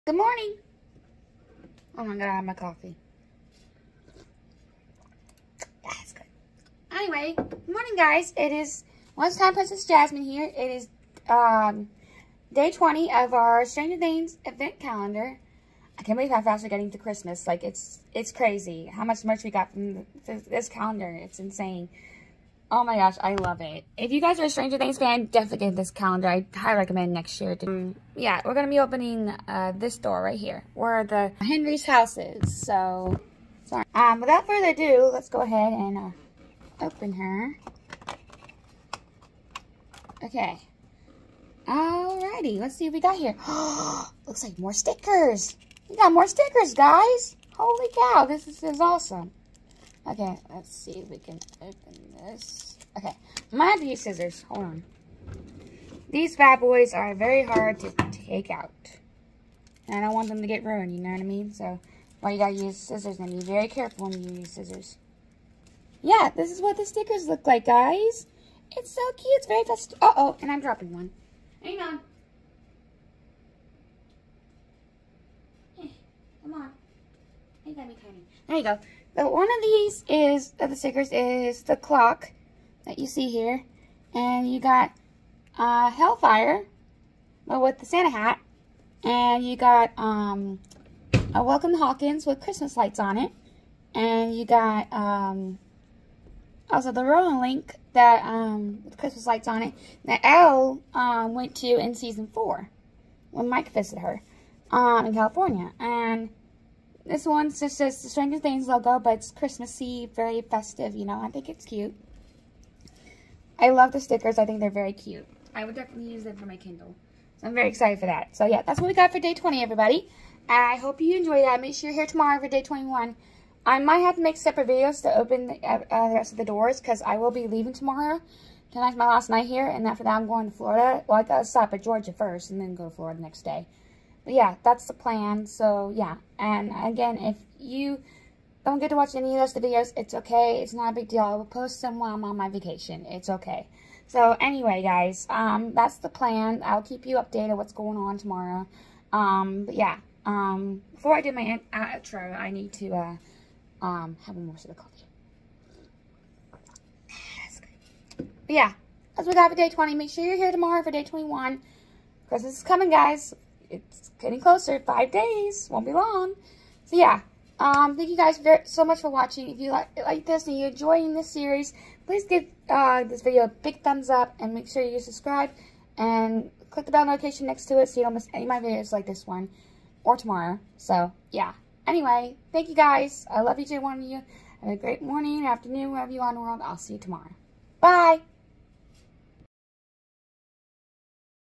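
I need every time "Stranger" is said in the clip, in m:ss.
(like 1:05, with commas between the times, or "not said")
0:13, 0:24, 1:48.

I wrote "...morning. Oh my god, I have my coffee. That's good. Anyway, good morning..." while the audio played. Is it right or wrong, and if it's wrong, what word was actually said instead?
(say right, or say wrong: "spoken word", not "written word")
right.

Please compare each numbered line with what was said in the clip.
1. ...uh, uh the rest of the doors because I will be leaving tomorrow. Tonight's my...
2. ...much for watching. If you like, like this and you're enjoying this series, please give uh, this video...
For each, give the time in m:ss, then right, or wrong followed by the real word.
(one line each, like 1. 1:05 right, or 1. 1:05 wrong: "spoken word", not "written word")
1. 2:05 right
2. 2:48 right.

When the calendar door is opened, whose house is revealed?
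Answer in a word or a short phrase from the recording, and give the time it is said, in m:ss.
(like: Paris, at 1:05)
Henry, at 0:31.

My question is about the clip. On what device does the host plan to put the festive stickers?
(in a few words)
Kindle.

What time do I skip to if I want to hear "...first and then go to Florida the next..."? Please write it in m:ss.
2:12.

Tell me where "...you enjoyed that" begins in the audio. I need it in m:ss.
2:01.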